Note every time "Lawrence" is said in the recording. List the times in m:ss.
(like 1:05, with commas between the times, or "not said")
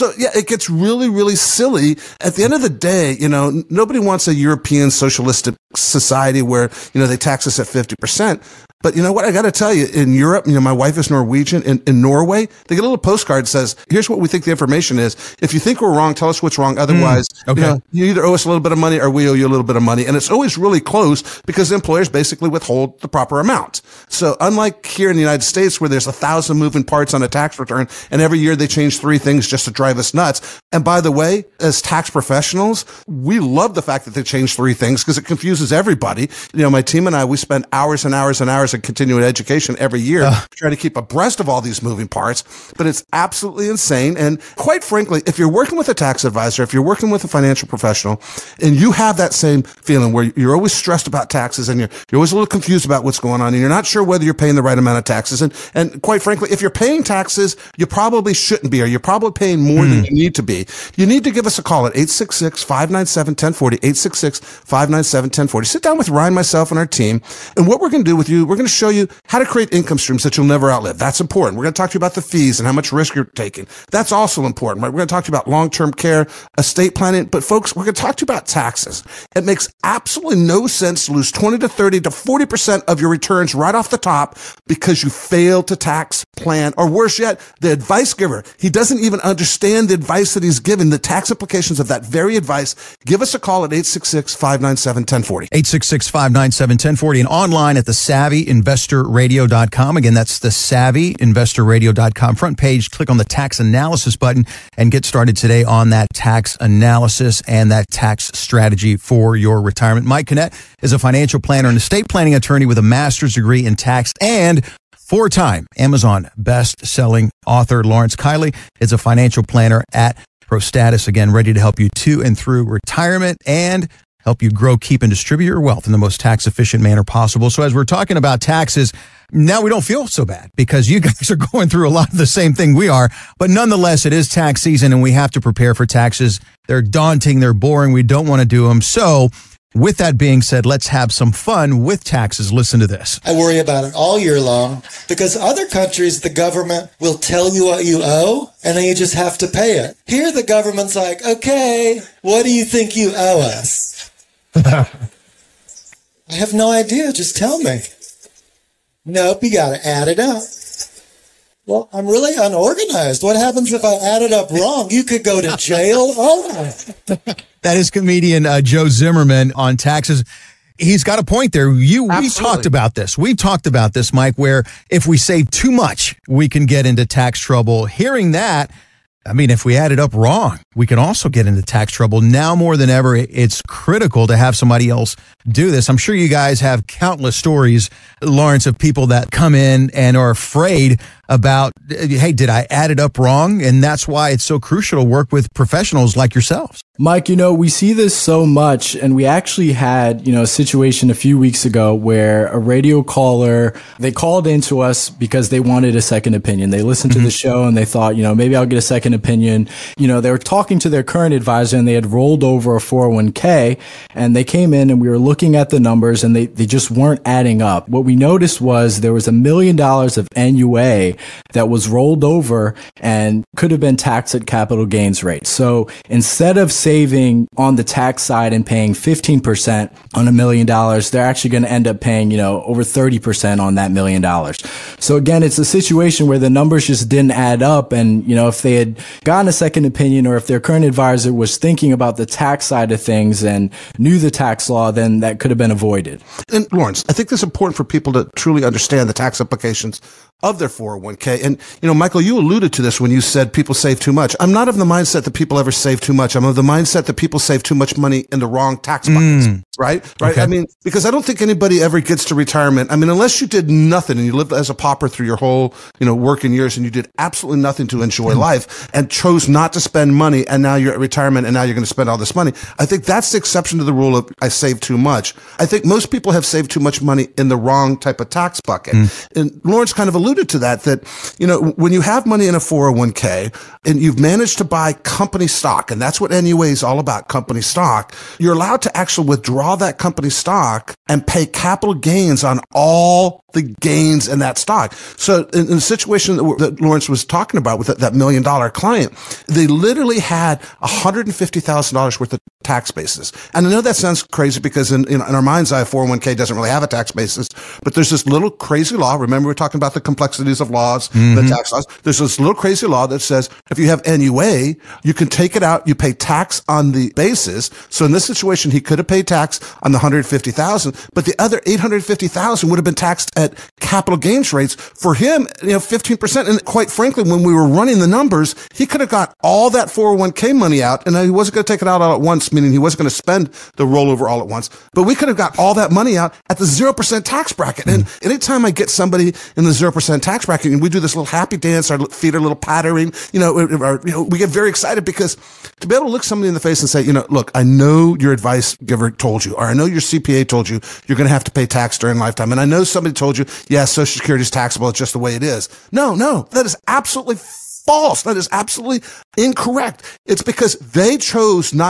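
1:57, 3:08, 4:06, 4:39, 4:56.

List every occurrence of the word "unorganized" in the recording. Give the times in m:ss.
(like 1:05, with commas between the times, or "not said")
2:42.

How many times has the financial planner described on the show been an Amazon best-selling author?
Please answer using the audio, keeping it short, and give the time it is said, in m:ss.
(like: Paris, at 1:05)
4, at 1:54.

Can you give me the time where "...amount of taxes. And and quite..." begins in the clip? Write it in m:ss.
0:54.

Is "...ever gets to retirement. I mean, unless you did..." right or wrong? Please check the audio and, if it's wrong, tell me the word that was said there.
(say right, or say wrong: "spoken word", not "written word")
right.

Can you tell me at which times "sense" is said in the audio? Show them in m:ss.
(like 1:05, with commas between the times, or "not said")
1:20.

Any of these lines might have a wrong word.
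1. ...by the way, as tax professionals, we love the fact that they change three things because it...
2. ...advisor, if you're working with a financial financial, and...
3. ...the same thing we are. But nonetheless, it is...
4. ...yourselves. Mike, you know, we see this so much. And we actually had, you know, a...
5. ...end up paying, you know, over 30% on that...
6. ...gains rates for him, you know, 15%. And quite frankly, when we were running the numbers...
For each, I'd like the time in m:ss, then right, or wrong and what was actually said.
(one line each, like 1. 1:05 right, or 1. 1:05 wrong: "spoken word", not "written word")
1. 0:30 right
2. 0:46 wrong: "professional", not "financial"
3. 2:12 right
4. 3:16 right
5. 3:51 right
6. 5:24 right.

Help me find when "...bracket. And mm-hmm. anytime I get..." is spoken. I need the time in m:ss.
5:37.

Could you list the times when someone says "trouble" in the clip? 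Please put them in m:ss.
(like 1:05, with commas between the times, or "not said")
2:57, 3:01.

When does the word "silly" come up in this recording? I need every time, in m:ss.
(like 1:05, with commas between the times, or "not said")
0:01.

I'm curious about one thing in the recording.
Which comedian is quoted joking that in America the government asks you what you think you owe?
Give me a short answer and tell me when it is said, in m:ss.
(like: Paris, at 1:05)
Joe Zimmerman, at 2:48.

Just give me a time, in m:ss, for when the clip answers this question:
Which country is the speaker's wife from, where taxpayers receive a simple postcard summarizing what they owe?
0:11.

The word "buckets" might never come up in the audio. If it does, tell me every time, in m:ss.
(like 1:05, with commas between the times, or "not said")
4:19, 4:38.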